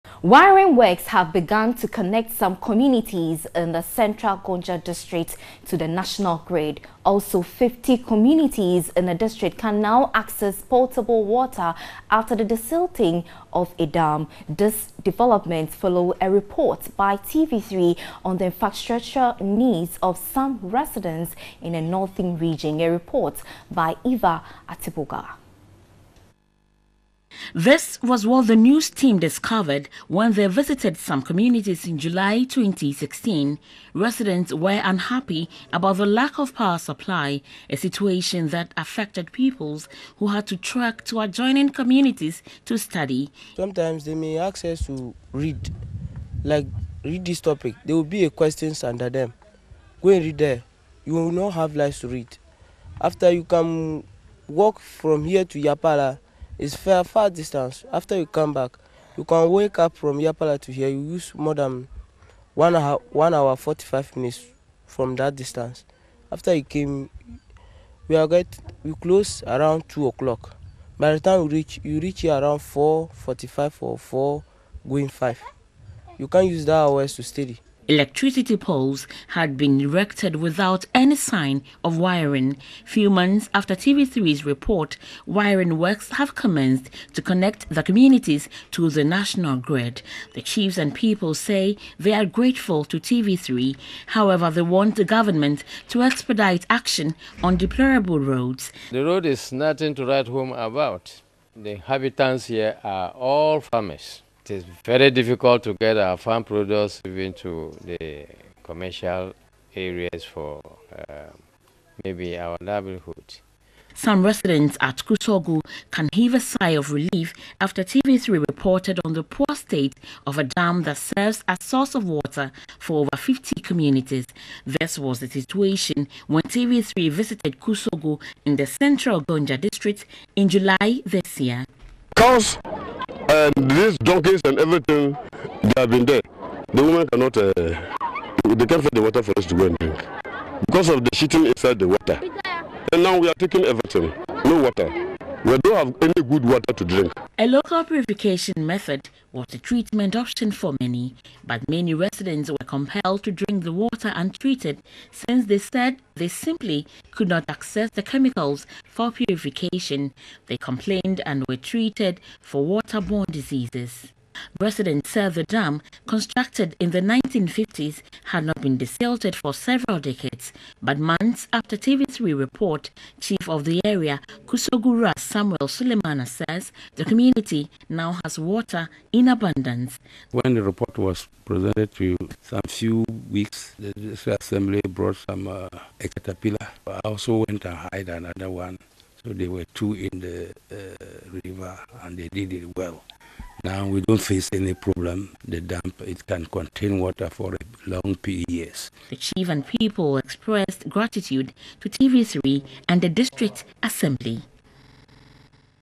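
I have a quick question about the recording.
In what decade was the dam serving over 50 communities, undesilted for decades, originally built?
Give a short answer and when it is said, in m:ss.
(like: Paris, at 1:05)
1950s, at 2:47.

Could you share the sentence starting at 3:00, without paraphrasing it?
When the report was presented to some few weeks, the district assembly brought some uh, a caterpillar.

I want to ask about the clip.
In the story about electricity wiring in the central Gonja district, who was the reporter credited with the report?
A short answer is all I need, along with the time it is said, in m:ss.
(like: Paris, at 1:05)
Eva Atiboga, at 0:24.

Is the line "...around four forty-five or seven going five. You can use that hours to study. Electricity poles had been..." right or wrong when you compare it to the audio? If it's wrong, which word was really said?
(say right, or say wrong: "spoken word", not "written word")
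wrong: "four", not "seven".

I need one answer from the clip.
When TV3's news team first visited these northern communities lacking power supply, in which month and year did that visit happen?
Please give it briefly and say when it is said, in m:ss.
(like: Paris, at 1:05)
July 2016, at 0:31.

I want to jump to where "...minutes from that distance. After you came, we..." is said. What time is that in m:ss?
1:04.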